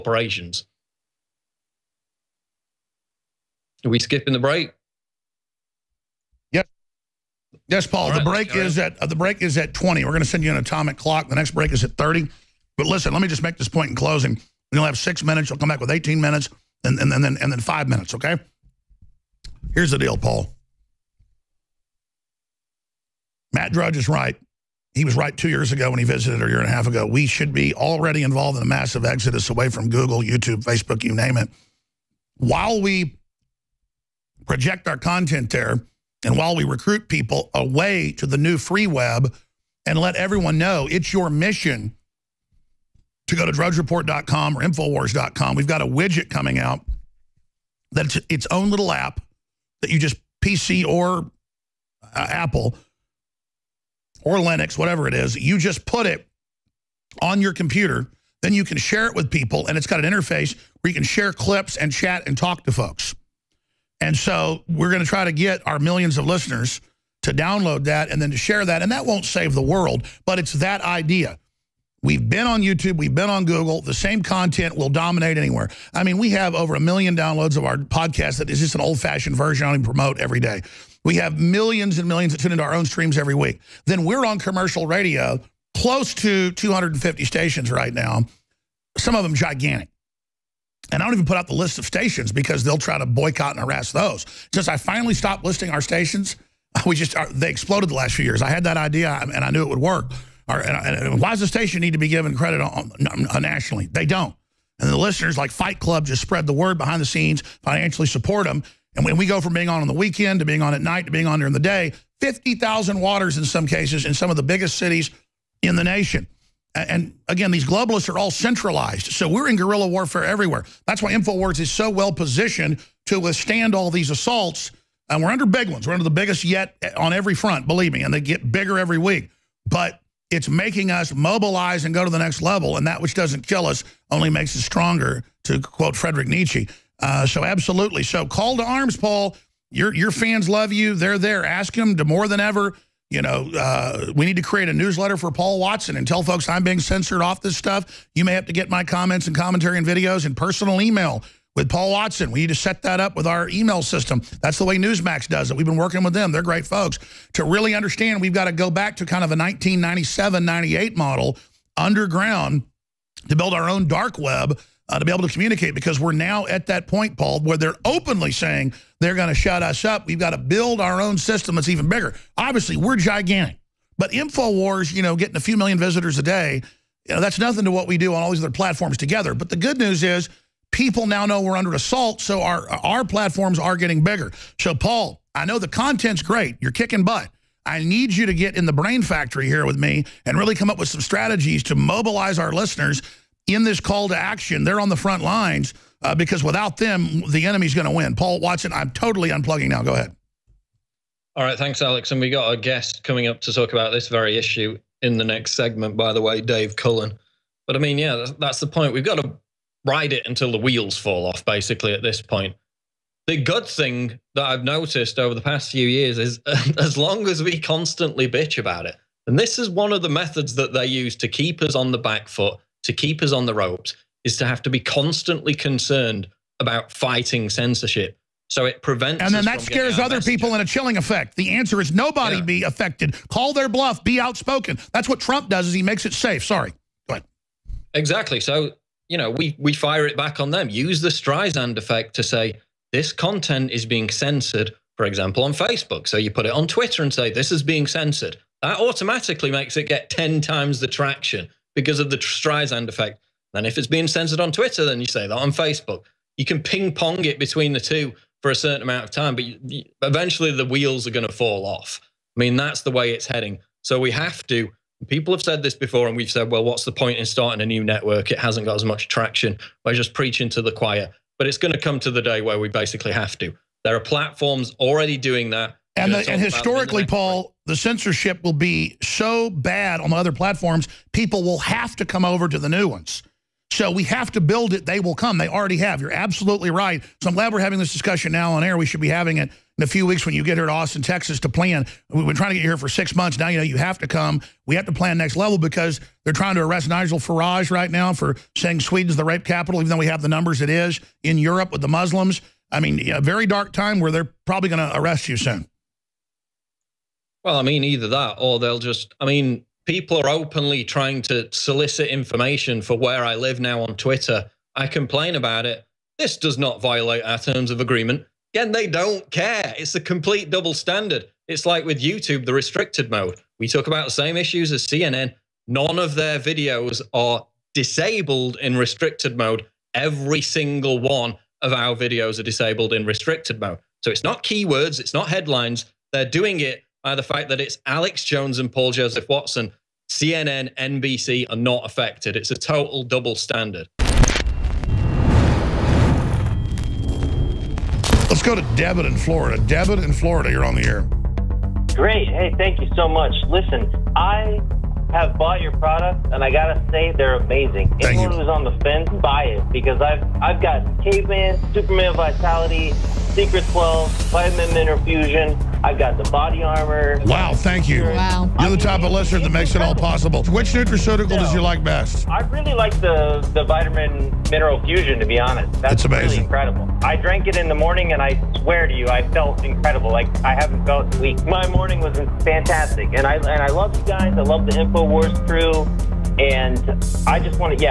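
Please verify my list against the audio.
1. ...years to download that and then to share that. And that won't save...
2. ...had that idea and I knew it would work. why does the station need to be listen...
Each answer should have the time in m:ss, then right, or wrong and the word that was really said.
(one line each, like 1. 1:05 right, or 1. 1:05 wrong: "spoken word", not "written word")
1. 1:06 wrong: "listeners", not "years"
2. 1:38 wrong: "given", not "listen".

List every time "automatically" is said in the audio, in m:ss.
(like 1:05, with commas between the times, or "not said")
4:08.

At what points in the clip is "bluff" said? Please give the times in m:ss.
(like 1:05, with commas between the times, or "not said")
3:53.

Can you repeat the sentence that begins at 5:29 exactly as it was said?
Every single one of our videos are disabled in restricted mode.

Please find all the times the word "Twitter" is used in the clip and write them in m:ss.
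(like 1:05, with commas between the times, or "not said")
4:06, 4:14, 5:13.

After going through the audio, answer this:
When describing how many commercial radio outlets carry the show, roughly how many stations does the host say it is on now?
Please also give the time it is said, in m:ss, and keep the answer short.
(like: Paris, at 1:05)
250, at 1:26.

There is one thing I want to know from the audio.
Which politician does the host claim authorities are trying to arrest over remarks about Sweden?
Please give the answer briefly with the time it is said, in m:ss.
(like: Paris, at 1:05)
Nigel Farage, at 4:56.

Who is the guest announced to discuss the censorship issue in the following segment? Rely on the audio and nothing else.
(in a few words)
Dave Cullen.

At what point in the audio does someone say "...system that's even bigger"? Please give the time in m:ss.
2:51.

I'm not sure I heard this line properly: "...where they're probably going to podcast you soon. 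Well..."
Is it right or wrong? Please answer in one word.
wrong.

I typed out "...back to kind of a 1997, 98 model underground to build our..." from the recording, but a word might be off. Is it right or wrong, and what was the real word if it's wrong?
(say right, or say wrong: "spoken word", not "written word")
right.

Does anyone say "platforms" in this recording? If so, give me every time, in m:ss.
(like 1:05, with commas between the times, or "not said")
2:58, 3:03, 4:33, 4:40.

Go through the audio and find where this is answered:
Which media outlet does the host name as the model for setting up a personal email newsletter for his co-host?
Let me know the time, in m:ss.
2:34.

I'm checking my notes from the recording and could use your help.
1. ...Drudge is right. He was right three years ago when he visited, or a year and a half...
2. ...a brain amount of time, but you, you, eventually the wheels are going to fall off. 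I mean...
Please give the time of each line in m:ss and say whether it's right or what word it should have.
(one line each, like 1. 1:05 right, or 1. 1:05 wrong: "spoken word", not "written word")
1. 0:23 wrong: "two", not "three"
2. 4:18 wrong: "certain", not "brain".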